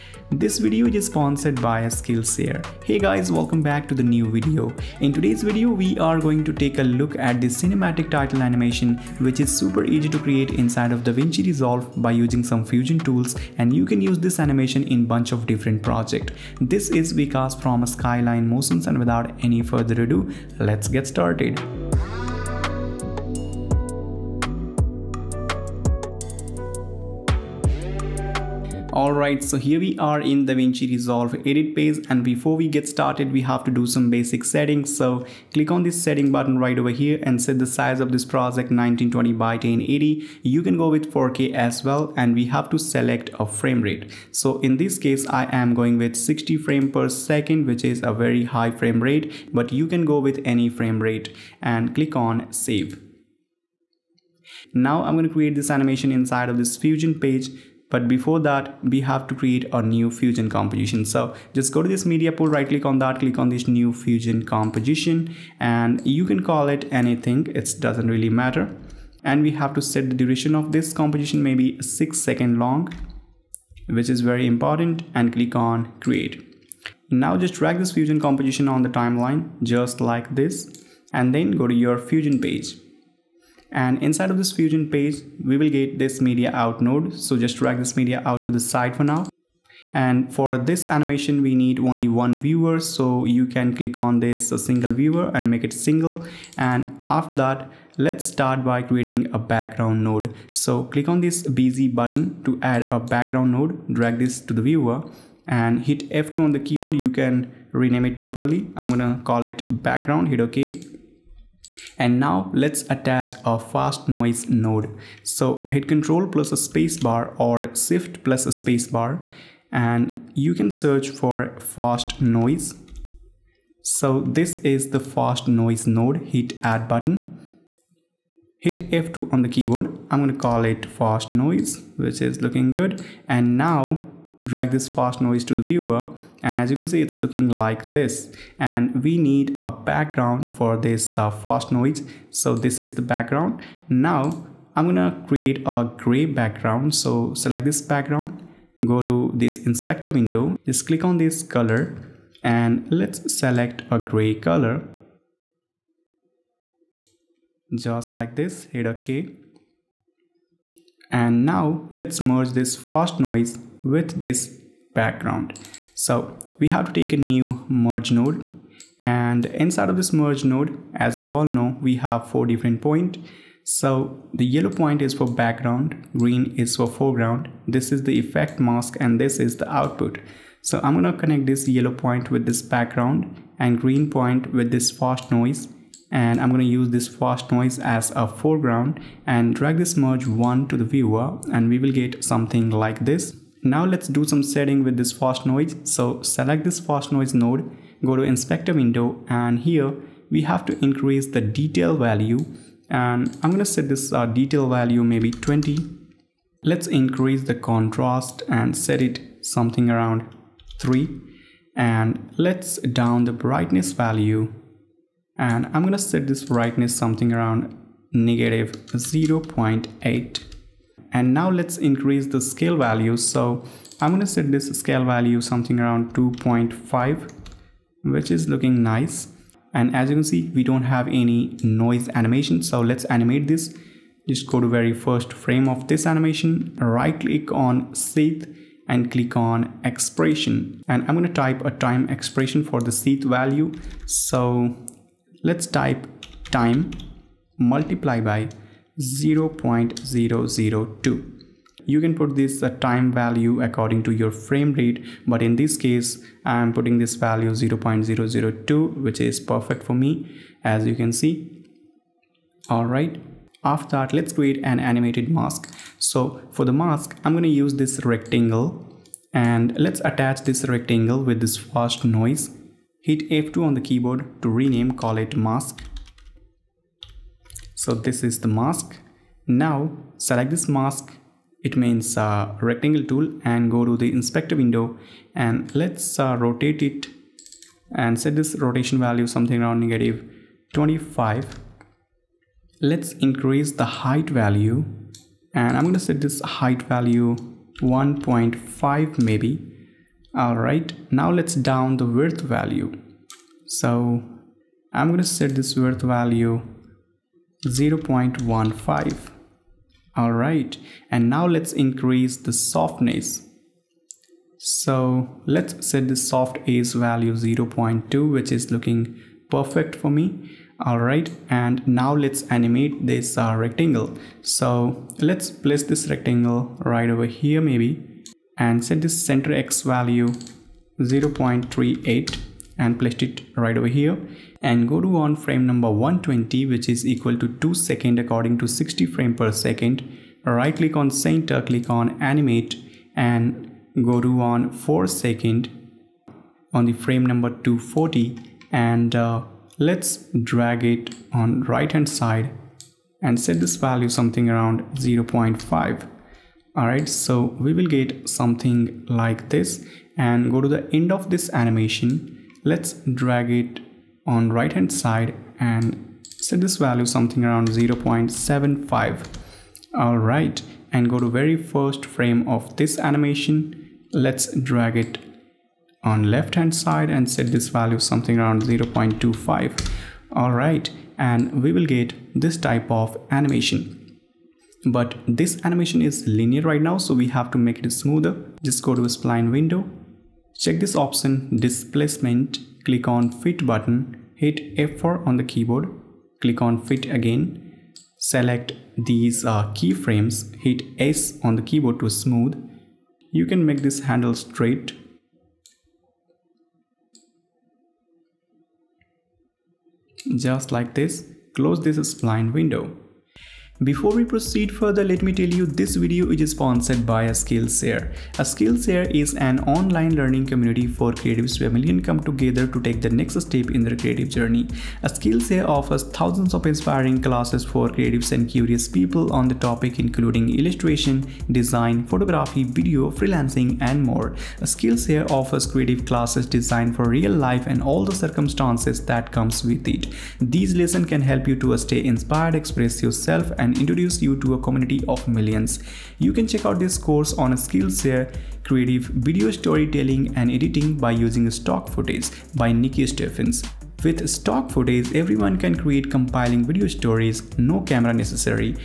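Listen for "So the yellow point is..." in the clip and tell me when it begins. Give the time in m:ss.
2:53.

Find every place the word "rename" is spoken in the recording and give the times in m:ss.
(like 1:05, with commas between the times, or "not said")
1:47, 4:34.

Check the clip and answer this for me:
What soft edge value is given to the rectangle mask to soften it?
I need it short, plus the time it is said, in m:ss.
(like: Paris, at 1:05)
0.2, at 5:17.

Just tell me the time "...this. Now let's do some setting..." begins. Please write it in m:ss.
3:13.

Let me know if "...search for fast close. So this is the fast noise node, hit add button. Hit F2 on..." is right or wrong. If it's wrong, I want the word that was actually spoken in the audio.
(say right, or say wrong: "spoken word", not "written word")
wrong: "noise", not "close".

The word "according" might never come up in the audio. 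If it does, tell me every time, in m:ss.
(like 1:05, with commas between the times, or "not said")
4:13, 5:38.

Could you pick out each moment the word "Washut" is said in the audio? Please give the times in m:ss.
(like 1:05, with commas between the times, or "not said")
not said.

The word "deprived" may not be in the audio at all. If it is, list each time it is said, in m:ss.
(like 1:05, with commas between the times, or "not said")
not said.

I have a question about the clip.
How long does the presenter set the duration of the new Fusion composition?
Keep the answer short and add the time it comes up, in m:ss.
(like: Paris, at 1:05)
6 seconds, at 1:11.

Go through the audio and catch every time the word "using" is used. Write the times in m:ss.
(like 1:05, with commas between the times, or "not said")
0:12, 7:31.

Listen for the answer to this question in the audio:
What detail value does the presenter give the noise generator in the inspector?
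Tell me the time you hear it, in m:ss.
3:25.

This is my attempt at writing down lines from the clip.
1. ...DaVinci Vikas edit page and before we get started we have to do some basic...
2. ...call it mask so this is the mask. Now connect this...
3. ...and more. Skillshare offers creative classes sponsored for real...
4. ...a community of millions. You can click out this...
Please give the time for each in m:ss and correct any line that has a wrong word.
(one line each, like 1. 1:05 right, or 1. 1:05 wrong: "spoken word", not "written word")
1. 0:30 wrong: "Resolve", not "Vikas"
2. 4:34 wrong: "select", not "connect"
3. 7:13 wrong: "designed", not "sponsored"
4. 7:24 wrong: "check", not "click".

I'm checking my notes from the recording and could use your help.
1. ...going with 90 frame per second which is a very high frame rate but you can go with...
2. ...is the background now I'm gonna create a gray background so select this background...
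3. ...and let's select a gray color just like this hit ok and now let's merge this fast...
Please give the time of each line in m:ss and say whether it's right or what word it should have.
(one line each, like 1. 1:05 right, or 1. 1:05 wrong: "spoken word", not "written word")
1. 0:45 wrong: "60", not "90"
2. 2:22 right
3. 2:32 right.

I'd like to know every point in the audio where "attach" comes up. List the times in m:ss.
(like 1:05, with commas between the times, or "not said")
1:52, 4:30.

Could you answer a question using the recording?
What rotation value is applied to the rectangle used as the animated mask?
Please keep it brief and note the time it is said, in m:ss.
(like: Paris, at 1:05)
-25, at 4:49.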